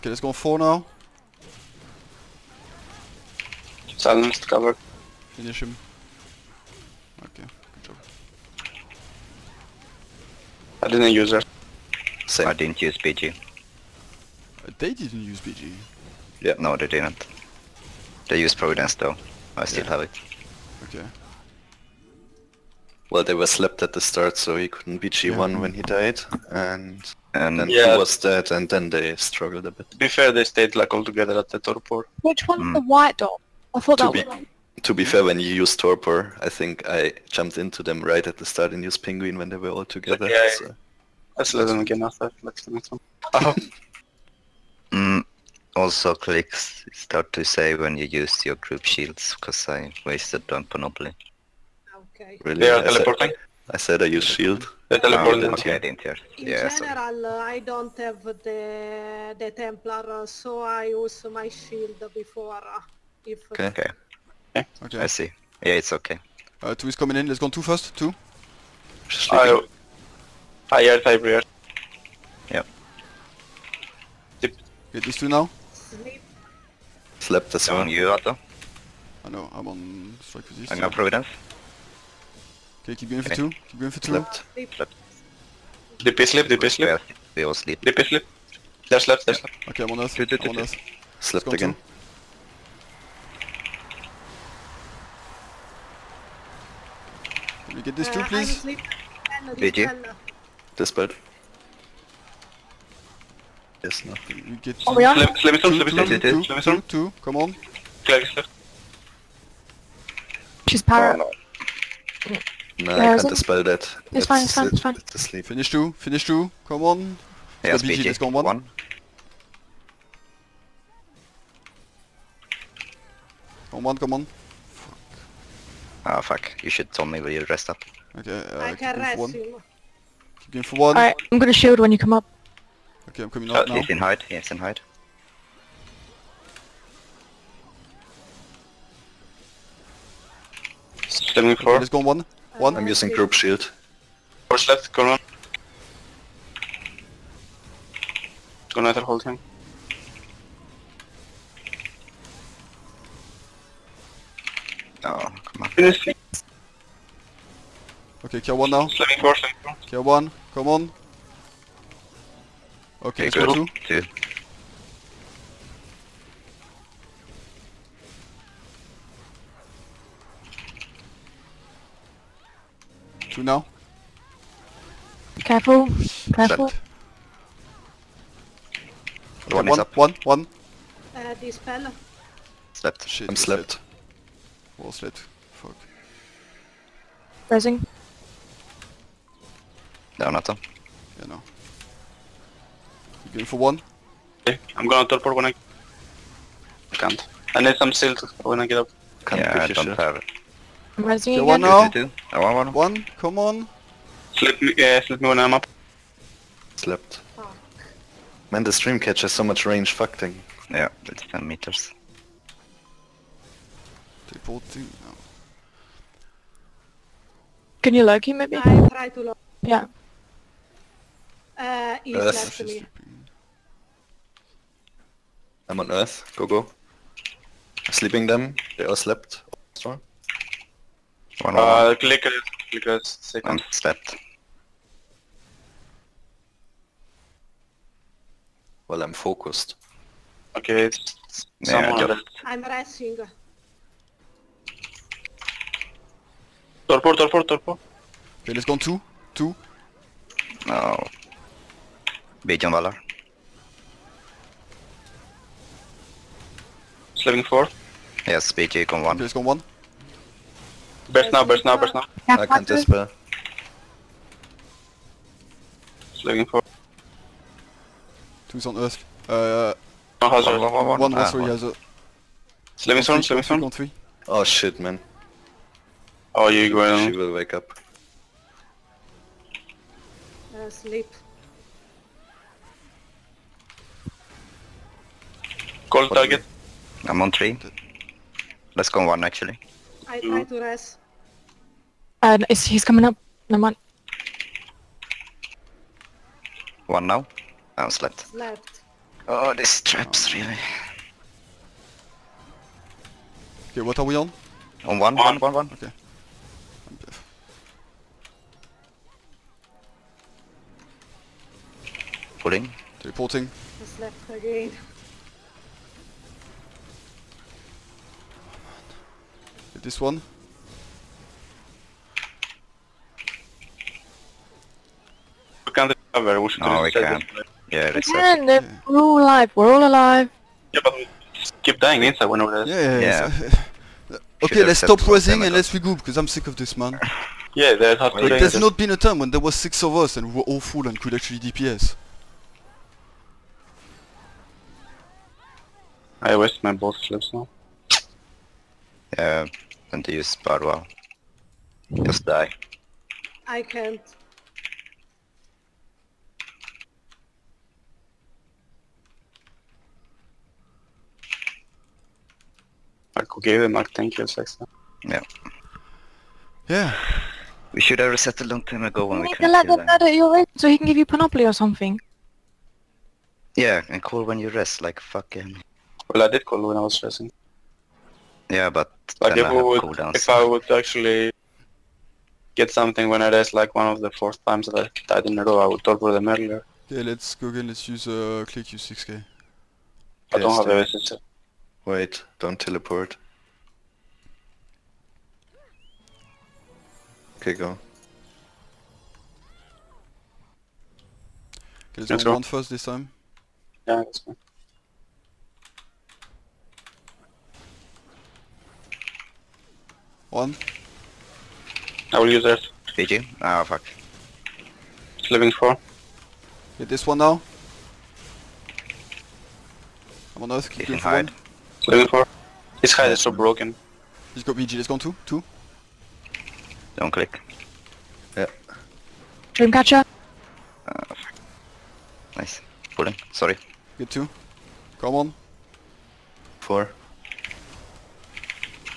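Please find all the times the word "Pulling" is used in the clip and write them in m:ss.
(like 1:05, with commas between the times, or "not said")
5:12, 7:12.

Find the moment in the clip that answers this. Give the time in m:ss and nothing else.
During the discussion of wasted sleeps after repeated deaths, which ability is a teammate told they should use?
5:50.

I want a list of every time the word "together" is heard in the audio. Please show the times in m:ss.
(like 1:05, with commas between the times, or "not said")
0:31, 0:39.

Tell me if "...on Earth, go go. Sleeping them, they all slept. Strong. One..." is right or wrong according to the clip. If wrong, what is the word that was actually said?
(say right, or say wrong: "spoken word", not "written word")
right.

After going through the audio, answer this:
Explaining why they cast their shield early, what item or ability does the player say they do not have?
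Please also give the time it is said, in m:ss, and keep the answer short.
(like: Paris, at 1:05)
Templar, at 0:59.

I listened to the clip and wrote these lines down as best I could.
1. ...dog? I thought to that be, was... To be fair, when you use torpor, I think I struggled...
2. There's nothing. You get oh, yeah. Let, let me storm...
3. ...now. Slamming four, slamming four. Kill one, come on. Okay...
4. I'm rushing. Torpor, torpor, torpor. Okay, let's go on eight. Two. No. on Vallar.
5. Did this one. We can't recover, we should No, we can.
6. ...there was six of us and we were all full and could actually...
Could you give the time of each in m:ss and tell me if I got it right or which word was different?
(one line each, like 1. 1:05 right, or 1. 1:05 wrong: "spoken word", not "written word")
1. 0:33 wrong: "jumped", not "struggled"
2. 1:43 right
3. 2:38 right
4. 4:02 wrong: "two", not "eight"
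5. 5:19 right
6. 5:39 right.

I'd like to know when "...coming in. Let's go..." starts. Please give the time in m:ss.
1:06.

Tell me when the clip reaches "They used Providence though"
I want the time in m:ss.
0:18.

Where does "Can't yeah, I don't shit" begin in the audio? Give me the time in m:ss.
3:19.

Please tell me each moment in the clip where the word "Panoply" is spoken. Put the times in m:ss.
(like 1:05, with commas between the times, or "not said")
0:50, 6:11.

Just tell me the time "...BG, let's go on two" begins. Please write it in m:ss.
7:04.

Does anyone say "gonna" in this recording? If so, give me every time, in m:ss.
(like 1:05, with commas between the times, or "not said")
2:11, 3:14.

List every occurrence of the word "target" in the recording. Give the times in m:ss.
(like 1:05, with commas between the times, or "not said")
4:46.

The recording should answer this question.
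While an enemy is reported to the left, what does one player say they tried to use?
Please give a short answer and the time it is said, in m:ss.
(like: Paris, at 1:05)
Loki, at 3:39.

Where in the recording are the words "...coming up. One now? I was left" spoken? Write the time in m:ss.
4:52.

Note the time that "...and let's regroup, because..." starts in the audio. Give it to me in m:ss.
5:35.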